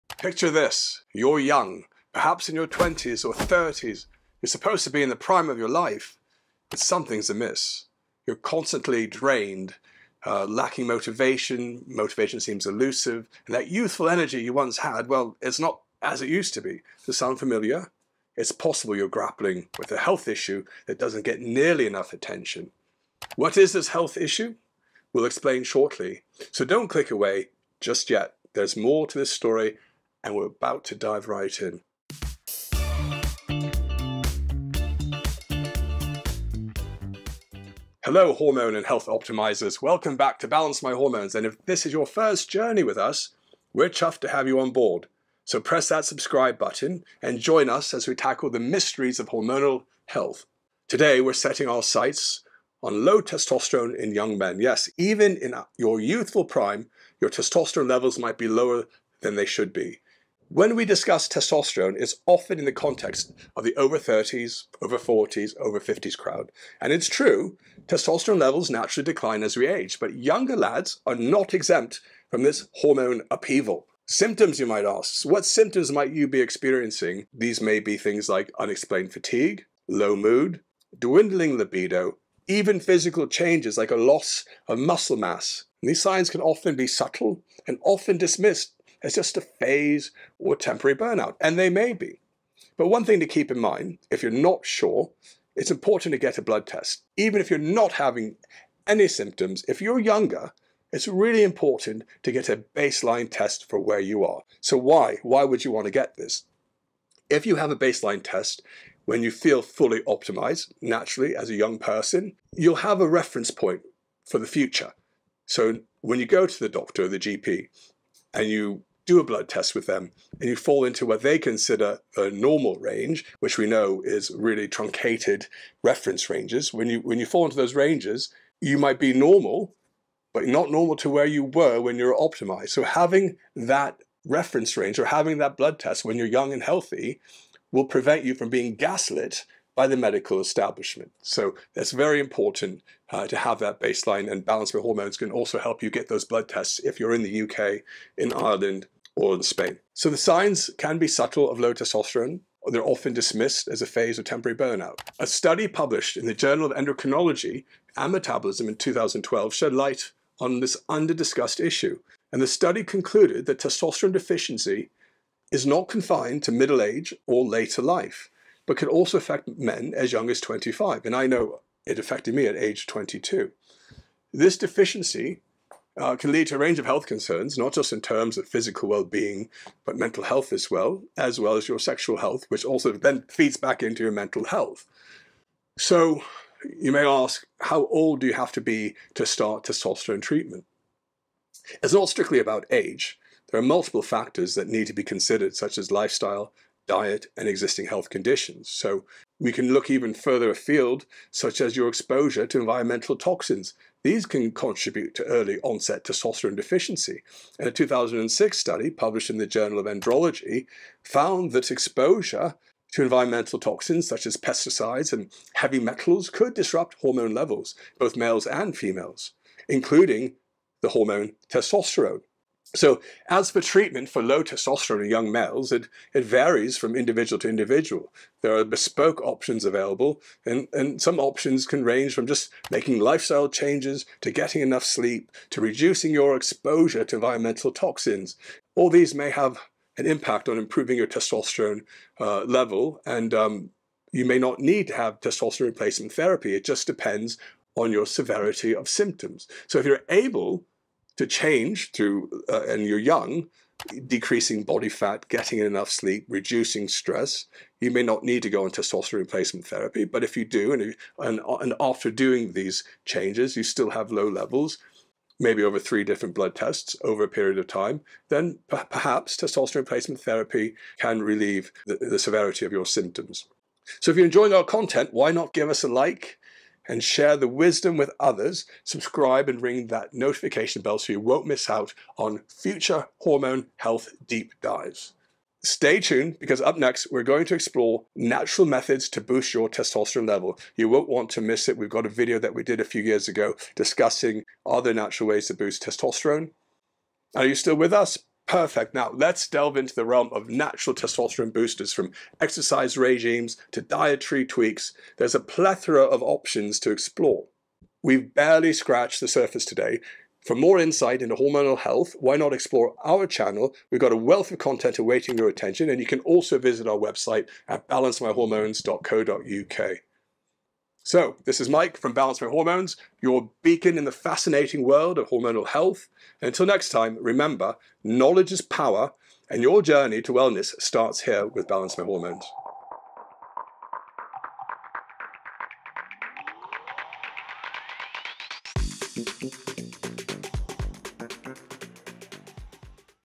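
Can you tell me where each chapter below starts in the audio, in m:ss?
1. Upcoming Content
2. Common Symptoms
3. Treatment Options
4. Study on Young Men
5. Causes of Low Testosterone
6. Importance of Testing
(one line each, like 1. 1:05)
1. 4:40
2. 1:13
3. 3:45
4. 2:35
5. 3:30
6. 1:36.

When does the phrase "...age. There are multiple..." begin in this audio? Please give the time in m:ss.
3:12.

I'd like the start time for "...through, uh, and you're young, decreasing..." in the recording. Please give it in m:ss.
4:11.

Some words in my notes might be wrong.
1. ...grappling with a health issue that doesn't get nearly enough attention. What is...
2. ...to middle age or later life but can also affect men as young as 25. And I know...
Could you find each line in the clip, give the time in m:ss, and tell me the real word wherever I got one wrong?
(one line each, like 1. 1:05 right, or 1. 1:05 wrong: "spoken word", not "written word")
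1. 0:19 right
2. 2:46 right.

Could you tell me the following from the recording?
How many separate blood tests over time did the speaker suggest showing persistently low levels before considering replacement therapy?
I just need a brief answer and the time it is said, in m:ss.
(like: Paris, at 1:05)
3, at 4:25.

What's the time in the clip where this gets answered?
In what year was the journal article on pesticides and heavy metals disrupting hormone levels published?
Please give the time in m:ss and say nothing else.
3:27.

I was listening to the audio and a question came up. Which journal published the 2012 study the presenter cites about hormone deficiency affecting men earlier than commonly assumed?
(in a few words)
Journal of Endocrinology and Metabolism.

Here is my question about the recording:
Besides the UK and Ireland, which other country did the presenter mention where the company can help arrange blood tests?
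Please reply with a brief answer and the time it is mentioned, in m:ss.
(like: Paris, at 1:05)
Spain, at 2:29.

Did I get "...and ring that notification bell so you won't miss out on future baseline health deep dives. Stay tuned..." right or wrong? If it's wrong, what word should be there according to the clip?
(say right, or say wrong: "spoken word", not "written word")
wrong: "hormone", not "baseline".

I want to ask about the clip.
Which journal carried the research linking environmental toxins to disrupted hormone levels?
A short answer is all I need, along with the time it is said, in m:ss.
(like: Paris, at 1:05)
Journal of Andrology, at 3:29.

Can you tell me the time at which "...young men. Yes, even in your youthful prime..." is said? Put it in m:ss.
0:54.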